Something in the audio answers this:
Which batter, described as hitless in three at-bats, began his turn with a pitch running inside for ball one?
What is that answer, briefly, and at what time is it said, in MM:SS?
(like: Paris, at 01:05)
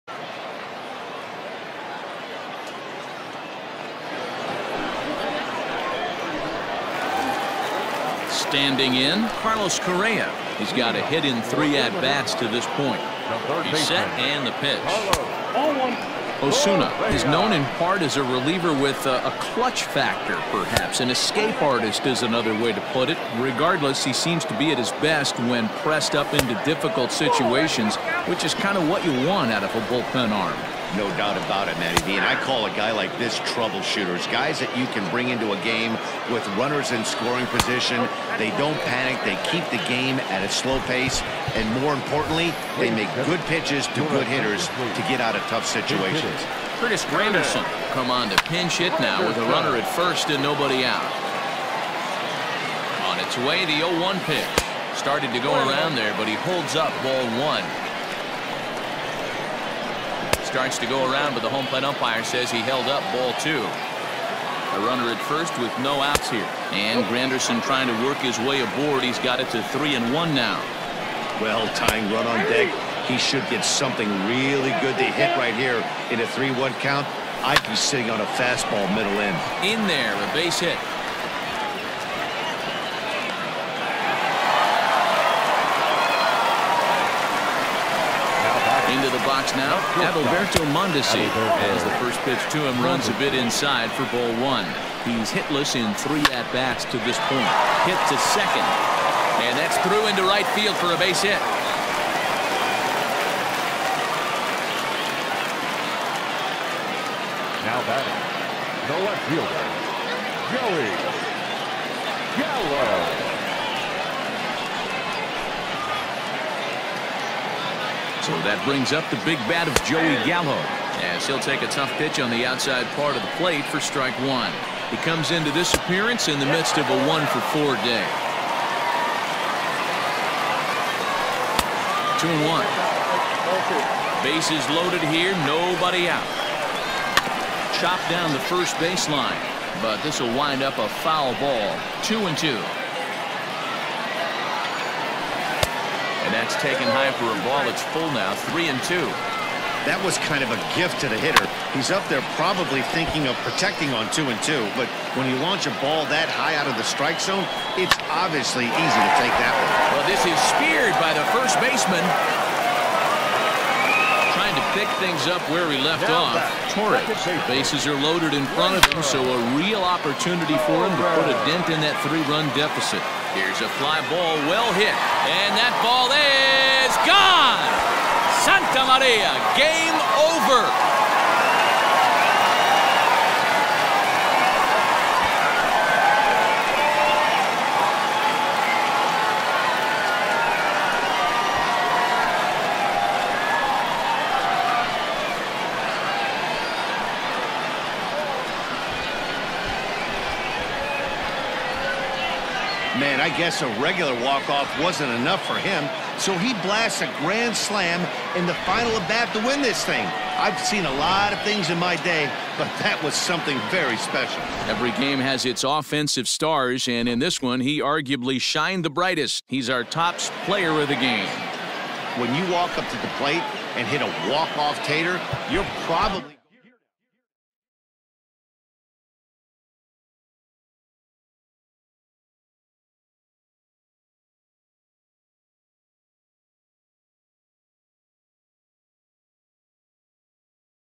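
Adalberto Mondesi, at 01:30.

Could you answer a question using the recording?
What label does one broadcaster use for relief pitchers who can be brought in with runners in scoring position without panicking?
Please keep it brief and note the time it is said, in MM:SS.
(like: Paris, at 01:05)
Troubleshooters, at 00:33.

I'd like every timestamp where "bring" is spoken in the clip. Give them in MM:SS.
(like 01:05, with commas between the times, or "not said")
00:35, 01:58.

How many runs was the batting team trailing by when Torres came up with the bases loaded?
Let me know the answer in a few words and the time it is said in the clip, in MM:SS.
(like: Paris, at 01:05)
3, at 02:52.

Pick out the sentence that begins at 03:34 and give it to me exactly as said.
Every game has its offensive stars, and in this one, he arguably shined the brightest.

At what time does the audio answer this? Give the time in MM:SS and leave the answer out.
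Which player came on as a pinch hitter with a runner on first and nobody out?
00:46.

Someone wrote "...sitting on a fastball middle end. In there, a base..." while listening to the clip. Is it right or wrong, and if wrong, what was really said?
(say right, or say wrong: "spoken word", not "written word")
right.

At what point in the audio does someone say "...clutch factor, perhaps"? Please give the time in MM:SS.
00:19.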